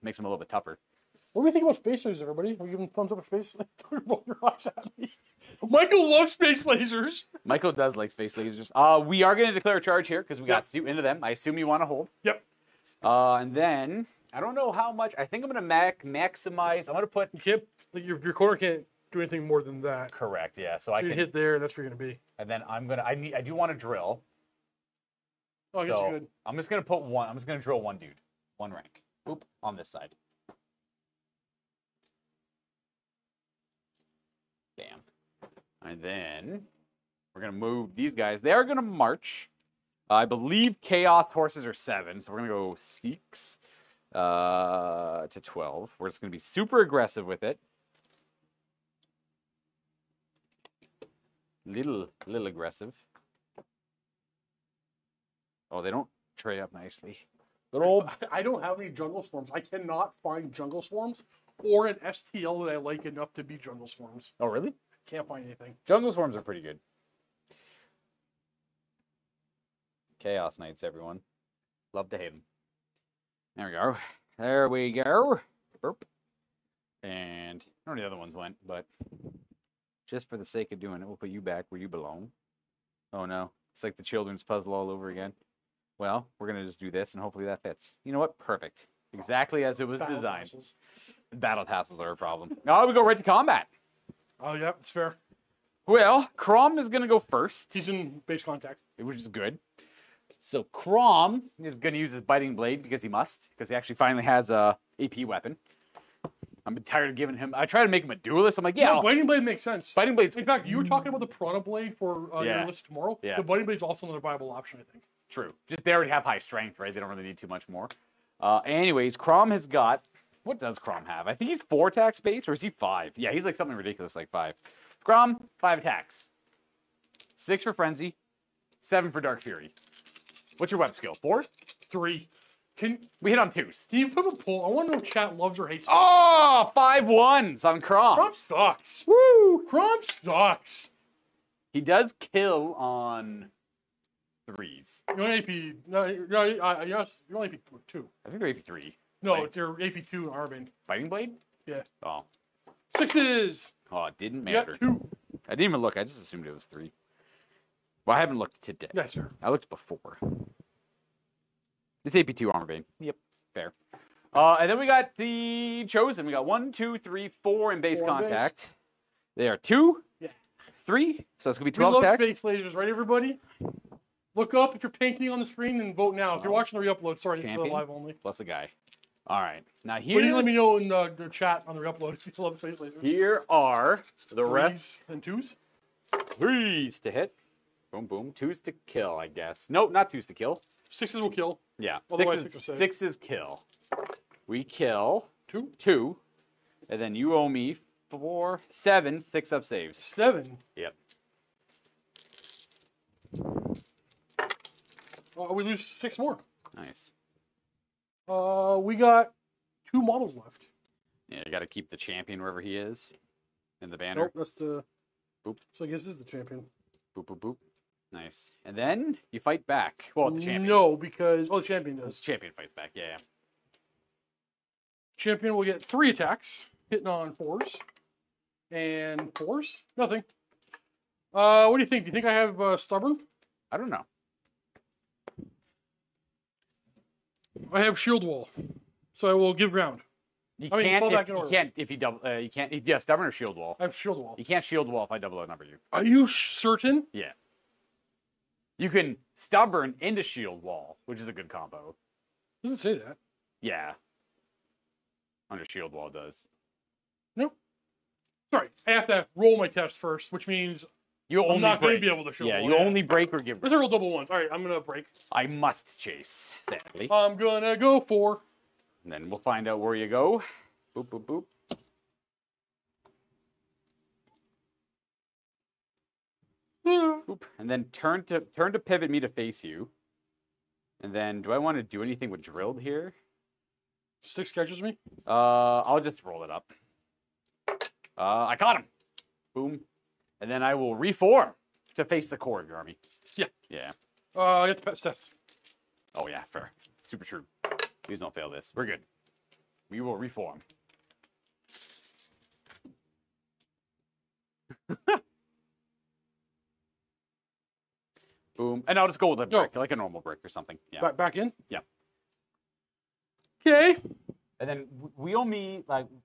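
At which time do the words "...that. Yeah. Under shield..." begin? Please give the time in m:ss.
4:12.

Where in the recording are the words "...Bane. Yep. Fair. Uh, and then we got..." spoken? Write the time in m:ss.
2:42.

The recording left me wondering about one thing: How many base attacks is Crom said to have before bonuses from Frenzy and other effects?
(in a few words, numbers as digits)
5.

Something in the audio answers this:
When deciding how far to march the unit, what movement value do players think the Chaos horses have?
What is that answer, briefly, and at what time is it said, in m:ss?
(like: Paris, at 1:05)
7, at 0:40.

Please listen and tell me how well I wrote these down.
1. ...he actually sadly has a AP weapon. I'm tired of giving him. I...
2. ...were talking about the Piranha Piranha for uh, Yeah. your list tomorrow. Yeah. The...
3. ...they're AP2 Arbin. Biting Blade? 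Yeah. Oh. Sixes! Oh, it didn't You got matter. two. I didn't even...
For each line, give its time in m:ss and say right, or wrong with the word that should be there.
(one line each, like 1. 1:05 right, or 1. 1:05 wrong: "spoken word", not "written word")
1. 1:43 wrong: "finally", not "sadly"
2. 1:50 wrong: "Blade", not "Piranha"
3. 2:29 right.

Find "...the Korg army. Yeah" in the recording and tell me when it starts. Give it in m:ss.
4:52.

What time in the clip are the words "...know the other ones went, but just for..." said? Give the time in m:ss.
1:17.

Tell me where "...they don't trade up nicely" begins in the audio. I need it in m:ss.
0:55.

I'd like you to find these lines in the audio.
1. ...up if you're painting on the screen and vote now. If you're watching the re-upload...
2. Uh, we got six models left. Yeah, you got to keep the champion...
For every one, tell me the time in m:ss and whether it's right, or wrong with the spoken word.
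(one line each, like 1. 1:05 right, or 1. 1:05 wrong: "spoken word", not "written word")
1. 2:54 right
2. 3:28 wrong: "two", not "six".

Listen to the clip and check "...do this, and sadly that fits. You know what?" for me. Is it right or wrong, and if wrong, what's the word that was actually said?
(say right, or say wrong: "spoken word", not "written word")
wrong: "hopefully", not "sadly".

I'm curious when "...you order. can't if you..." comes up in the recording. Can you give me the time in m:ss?
4:01.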